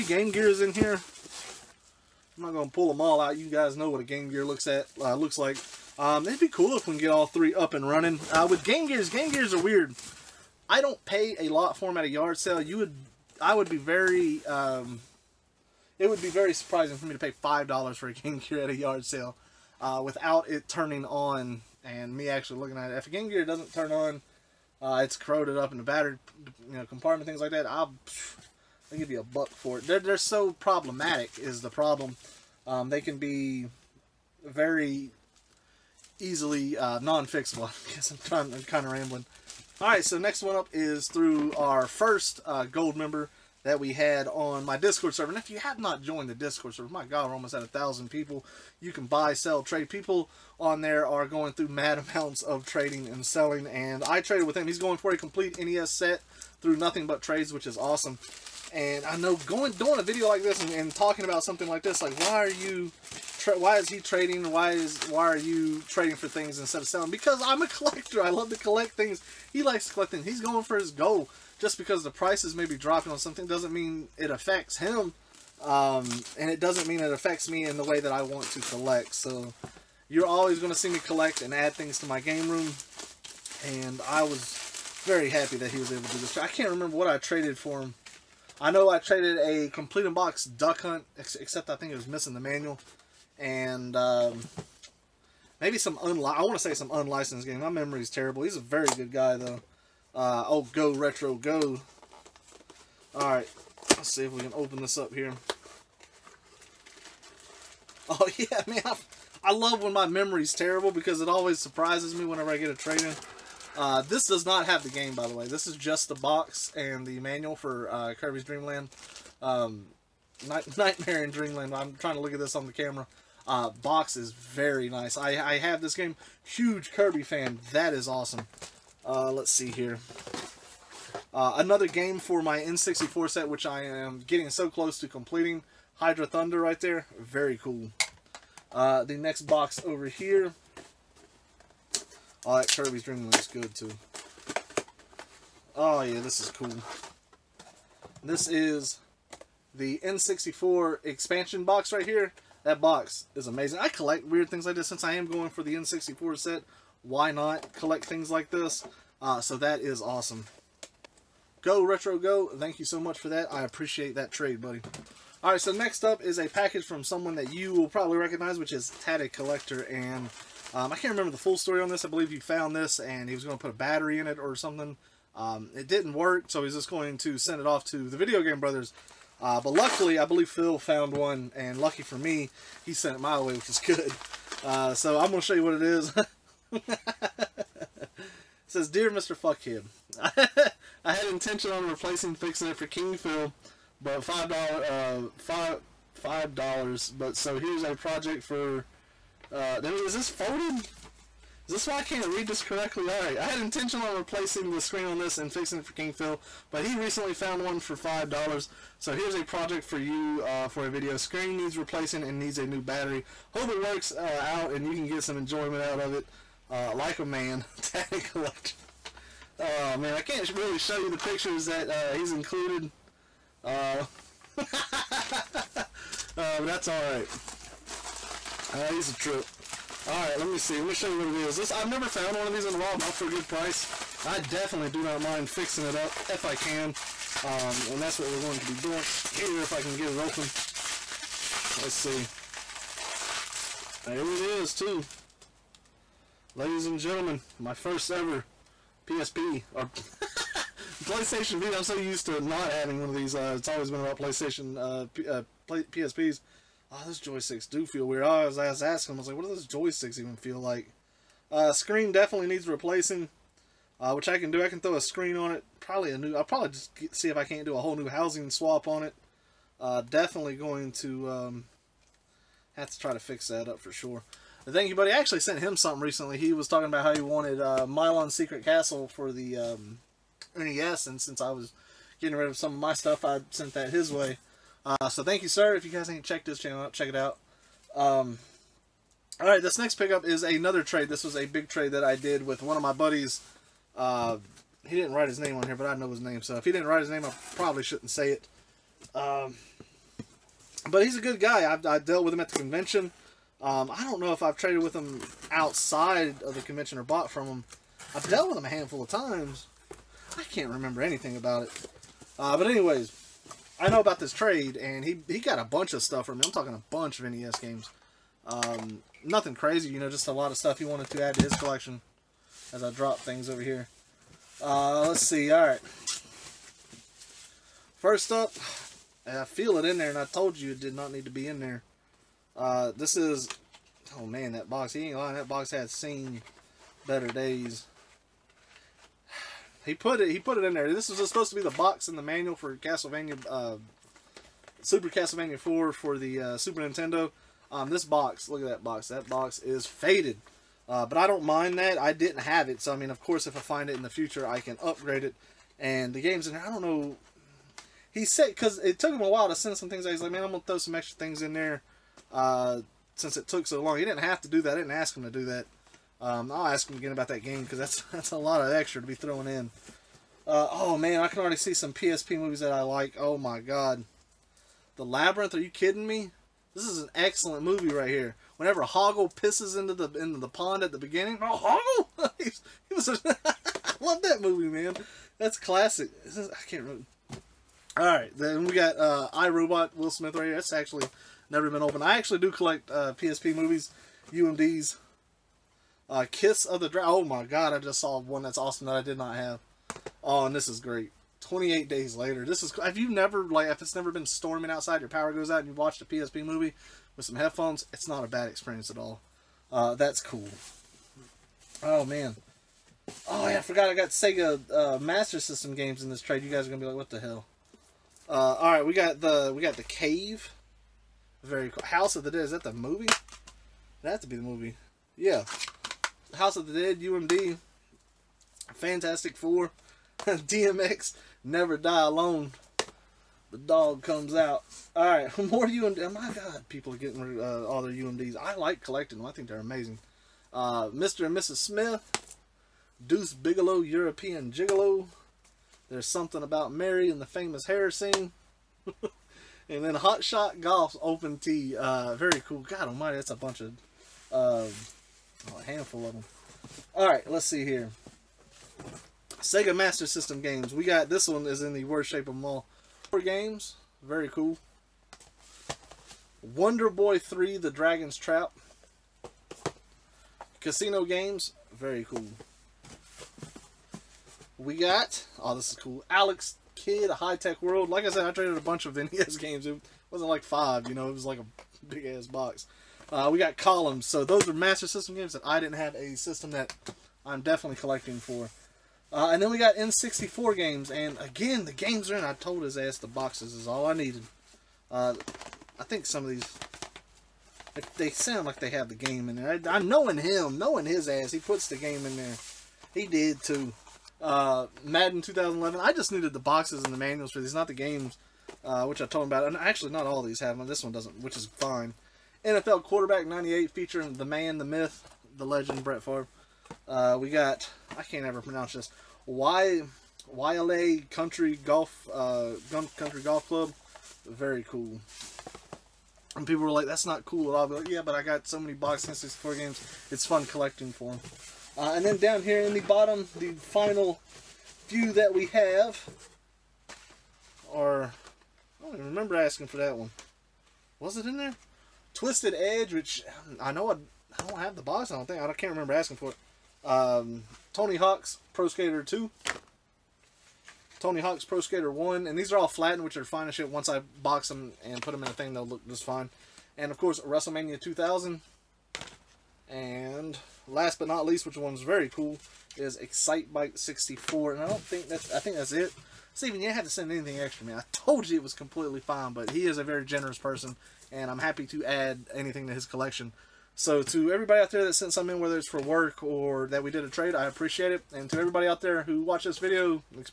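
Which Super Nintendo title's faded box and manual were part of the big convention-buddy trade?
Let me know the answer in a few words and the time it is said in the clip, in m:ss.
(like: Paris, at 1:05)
Super Castlevania 4, at 5:44.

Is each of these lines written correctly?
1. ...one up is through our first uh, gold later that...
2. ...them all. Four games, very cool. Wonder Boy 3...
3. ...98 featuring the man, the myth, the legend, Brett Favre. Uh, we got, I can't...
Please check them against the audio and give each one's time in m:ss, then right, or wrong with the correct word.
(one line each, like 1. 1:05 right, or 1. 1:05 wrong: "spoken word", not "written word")
1. 0:40 wrong: "member", not "later"
2. 7:42 right
3. 8:33 right.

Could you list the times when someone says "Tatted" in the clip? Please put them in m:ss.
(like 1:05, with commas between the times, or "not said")
2:49, 3:37.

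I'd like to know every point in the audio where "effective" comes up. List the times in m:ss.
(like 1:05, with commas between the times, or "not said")
not said.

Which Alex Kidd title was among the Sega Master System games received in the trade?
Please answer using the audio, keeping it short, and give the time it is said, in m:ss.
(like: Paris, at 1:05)
Alex Kidd High Tech World, at 7:56.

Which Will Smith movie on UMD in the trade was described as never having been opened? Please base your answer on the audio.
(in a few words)
iRobot.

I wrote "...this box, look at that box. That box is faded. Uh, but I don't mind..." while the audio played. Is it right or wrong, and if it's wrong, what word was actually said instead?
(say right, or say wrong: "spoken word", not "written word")
right.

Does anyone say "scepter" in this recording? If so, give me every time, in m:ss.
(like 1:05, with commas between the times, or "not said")
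not said.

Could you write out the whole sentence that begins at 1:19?
So you're always going to see me collect and add things to my game room.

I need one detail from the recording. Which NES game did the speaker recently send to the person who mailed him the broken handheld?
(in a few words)
Milon's Secret Castle.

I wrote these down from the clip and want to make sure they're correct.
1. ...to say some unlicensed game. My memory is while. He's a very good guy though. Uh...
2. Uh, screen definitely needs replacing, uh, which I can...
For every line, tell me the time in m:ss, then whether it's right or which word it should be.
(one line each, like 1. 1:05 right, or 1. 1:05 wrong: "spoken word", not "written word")
1. 1:36 wrong: "terrible", not "while"
2. 4:21 right.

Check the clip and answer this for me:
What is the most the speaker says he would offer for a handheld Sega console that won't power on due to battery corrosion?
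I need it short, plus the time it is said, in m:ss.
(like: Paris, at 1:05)
$1, at 0:28.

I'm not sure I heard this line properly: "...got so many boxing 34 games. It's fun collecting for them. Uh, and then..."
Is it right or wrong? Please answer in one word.
wrong.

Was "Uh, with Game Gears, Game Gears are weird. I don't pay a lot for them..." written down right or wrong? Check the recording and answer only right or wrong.
right.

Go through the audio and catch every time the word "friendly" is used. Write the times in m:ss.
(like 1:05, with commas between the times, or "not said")
not said.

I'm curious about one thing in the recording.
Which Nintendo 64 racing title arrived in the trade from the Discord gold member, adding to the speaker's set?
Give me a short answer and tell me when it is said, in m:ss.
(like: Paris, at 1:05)
Hydro Thunder, at 2:15.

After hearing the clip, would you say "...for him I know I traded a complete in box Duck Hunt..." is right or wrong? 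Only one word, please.
right.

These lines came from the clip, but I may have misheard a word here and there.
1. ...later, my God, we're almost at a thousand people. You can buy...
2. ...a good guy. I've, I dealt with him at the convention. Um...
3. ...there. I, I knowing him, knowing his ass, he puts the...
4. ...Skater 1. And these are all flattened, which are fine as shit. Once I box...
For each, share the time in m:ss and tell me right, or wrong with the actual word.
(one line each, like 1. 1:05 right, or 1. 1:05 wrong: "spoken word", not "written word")
1. 0:46 wrong: "server", not "later"
2. 5:01 right
3. 8:19 right
4. 9:11 right.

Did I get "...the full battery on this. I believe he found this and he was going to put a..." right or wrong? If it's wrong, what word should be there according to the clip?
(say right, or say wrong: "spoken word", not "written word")
wrong: "story", not "battery".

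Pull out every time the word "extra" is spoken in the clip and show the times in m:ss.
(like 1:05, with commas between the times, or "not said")
6:00, 6:08, 9:27.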